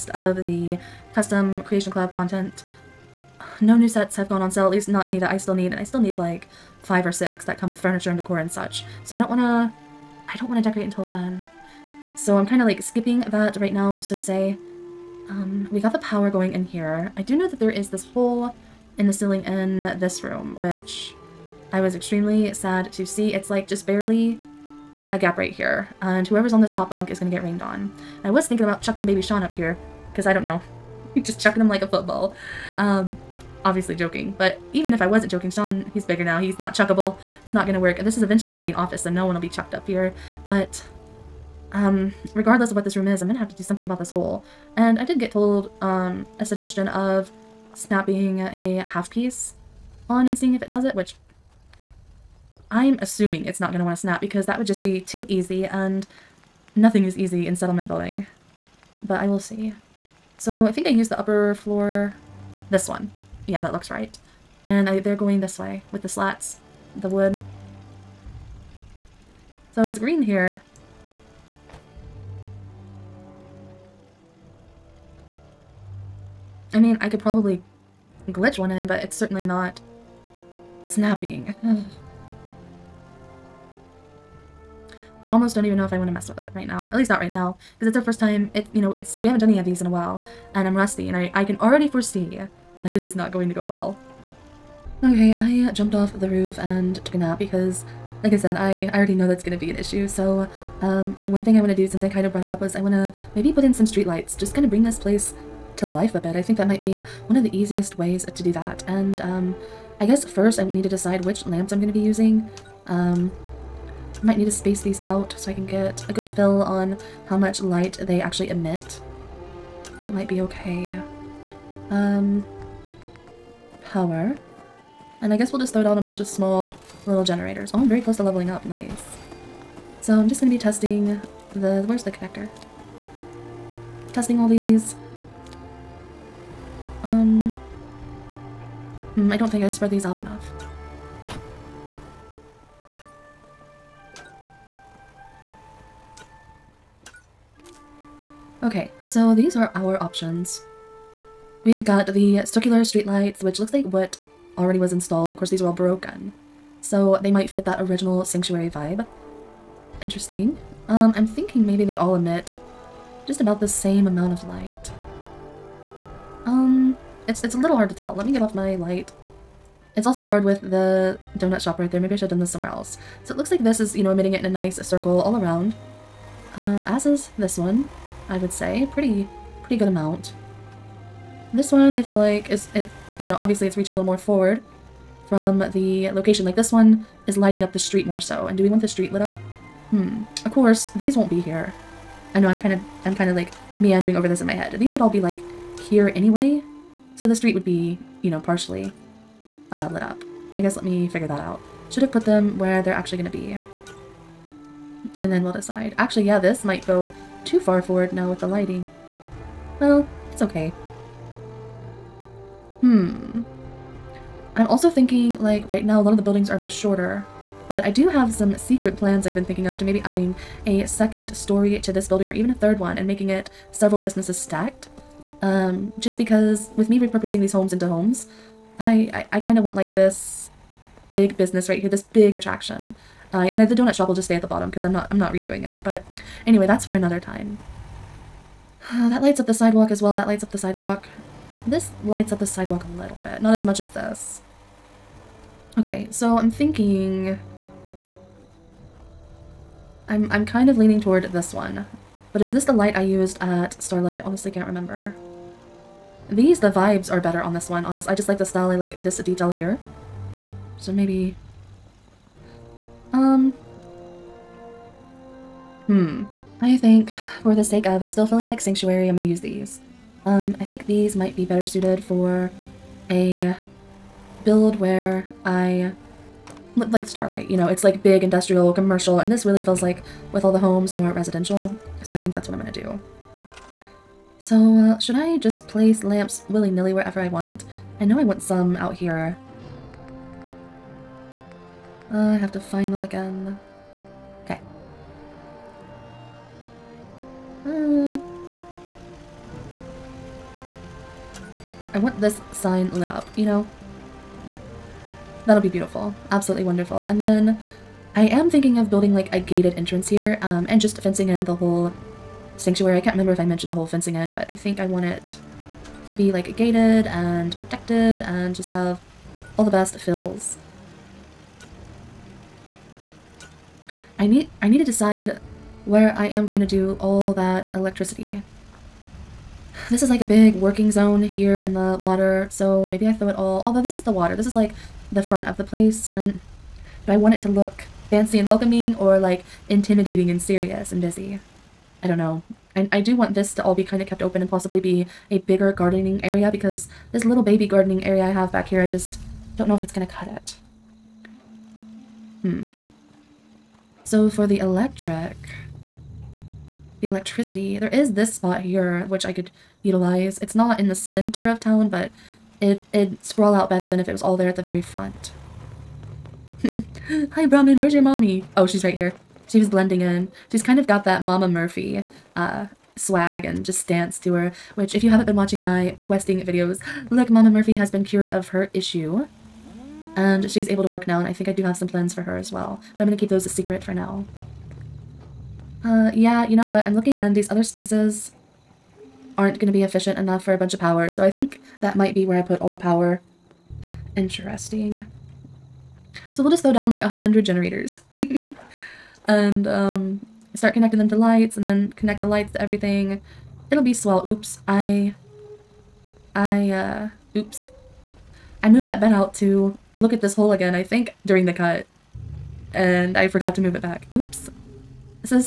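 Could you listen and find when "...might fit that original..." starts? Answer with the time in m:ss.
2:37.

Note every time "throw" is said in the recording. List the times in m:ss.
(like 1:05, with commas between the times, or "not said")
2:05, 5:33, 6:36.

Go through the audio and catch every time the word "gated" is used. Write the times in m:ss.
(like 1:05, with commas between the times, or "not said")
5:09, 5:16.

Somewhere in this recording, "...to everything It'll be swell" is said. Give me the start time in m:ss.
6:42.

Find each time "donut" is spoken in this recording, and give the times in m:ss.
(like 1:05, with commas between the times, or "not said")
2:51, 3:53.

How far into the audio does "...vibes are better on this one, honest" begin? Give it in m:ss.
4:16.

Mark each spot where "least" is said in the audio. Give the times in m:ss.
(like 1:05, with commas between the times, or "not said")
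0:04, 1:26.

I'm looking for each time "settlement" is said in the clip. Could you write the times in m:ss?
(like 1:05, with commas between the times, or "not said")
0:57.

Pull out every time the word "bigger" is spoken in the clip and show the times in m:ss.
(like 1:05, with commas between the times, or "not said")
0:36, 5:45.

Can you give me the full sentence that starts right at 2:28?
Okay, so these are our options.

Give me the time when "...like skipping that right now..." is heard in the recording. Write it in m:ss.
0:12.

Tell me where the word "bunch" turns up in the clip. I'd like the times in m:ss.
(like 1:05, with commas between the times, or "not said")
2:06, 6:30.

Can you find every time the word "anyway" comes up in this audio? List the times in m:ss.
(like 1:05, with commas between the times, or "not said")
3:16, 3:56.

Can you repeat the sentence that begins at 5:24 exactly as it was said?
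I need I need to decide where I am going to do all that electricity.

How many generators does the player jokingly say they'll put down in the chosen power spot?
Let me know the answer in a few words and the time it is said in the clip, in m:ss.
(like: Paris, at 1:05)
100, at 6:37.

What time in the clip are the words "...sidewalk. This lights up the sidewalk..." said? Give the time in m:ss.
4:00.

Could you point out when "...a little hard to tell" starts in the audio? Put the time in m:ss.
2:47.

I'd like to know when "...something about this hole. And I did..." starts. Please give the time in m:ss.
0:43.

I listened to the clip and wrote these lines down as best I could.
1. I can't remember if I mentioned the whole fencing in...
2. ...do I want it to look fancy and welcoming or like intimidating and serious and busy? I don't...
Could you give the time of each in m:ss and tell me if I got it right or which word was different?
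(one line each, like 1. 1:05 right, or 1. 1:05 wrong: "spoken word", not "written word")
1. 5:12 right
2. 5:37 right.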